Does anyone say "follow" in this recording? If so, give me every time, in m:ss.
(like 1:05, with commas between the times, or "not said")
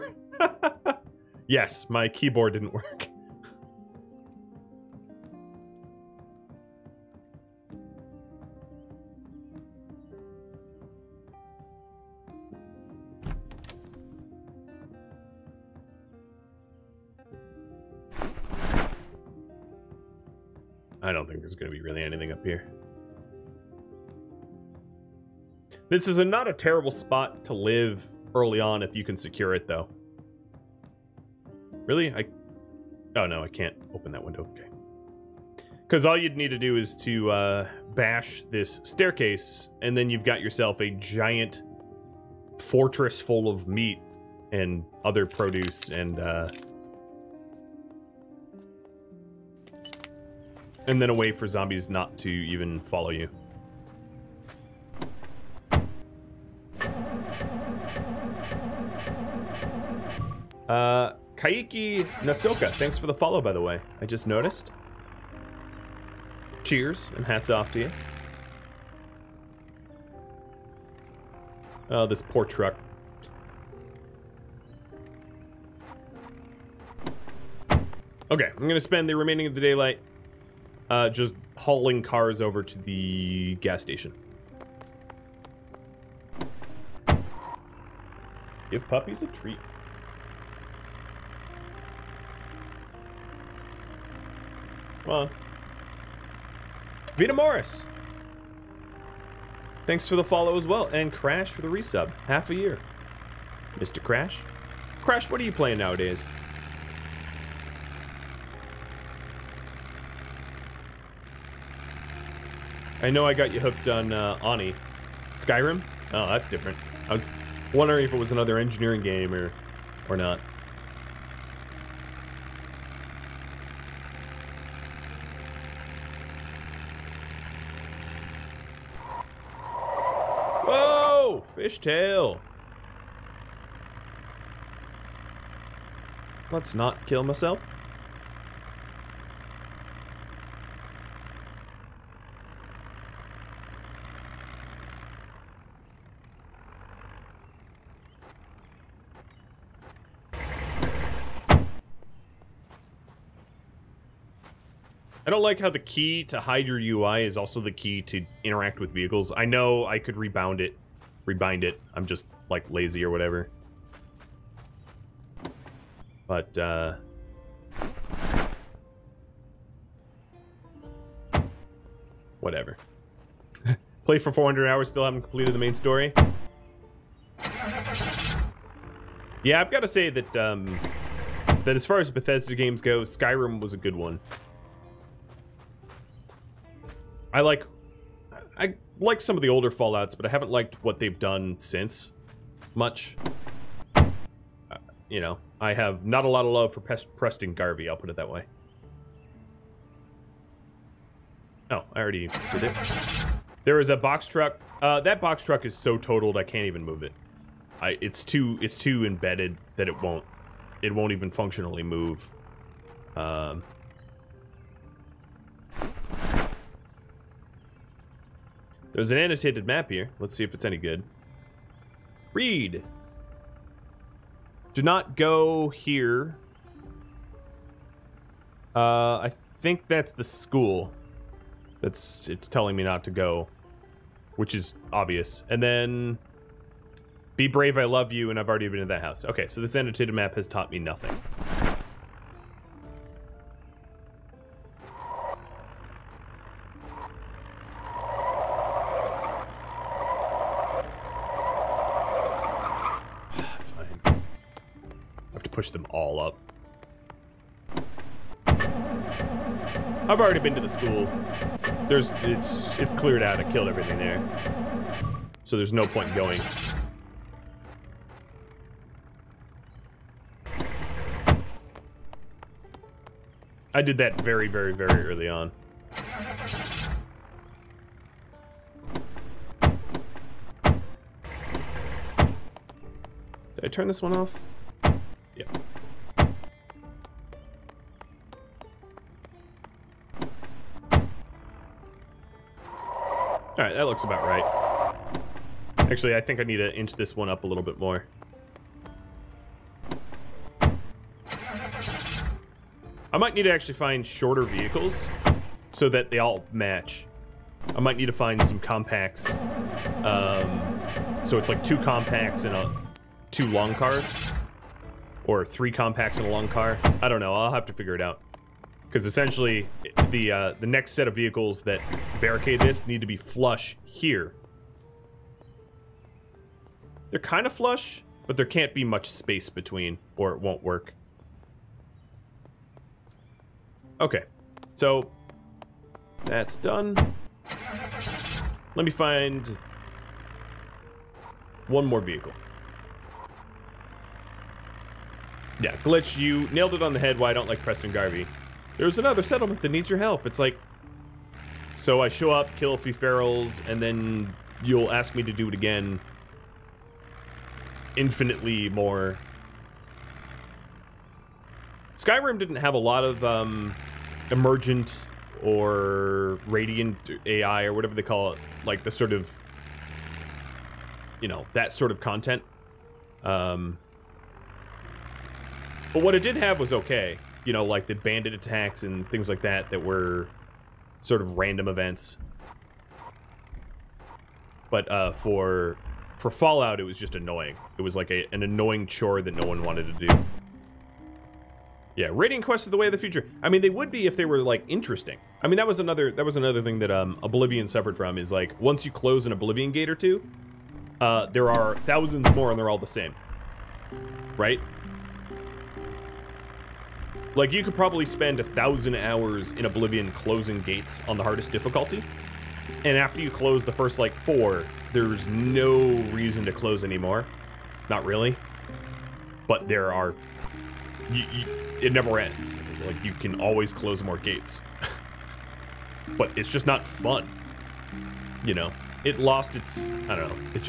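0:52, 1:03, 1:40.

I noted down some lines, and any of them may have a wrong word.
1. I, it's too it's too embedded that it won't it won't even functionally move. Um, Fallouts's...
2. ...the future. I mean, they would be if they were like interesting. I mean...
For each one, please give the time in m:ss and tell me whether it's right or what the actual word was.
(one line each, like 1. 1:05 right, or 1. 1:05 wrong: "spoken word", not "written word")
1. 3:27 wrong: "There", not "Fallouts"
2. 6:32 right.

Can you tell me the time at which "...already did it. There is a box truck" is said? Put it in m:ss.
3:21.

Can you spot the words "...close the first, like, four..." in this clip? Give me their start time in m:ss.
6:53.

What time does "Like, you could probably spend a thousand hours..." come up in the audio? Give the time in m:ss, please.
6:47.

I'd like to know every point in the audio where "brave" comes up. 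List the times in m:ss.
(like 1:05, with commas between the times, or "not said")
3:57.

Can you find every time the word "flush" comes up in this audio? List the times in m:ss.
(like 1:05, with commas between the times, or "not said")
5:23, 5:27.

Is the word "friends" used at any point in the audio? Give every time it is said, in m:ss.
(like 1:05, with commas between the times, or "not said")
not said.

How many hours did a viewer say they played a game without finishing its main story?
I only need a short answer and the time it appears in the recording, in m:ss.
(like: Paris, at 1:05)
400, at 2:54.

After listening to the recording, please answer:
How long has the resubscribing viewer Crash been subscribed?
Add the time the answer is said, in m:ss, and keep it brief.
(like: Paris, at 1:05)
Half a year, at 1:42.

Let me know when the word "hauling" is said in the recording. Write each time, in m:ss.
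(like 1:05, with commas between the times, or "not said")
1:21.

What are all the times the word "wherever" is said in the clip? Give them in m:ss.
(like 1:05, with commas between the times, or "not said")
not said.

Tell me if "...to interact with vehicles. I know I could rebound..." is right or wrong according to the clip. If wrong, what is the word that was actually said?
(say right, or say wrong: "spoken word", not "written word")
right.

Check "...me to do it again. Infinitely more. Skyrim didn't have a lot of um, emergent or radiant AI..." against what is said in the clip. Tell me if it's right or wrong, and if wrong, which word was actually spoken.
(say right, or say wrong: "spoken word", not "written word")
right.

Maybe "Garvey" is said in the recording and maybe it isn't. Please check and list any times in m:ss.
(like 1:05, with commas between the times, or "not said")
3:17, 5:47.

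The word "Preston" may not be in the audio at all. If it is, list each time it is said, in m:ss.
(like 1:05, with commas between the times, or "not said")
3:16, 5:47.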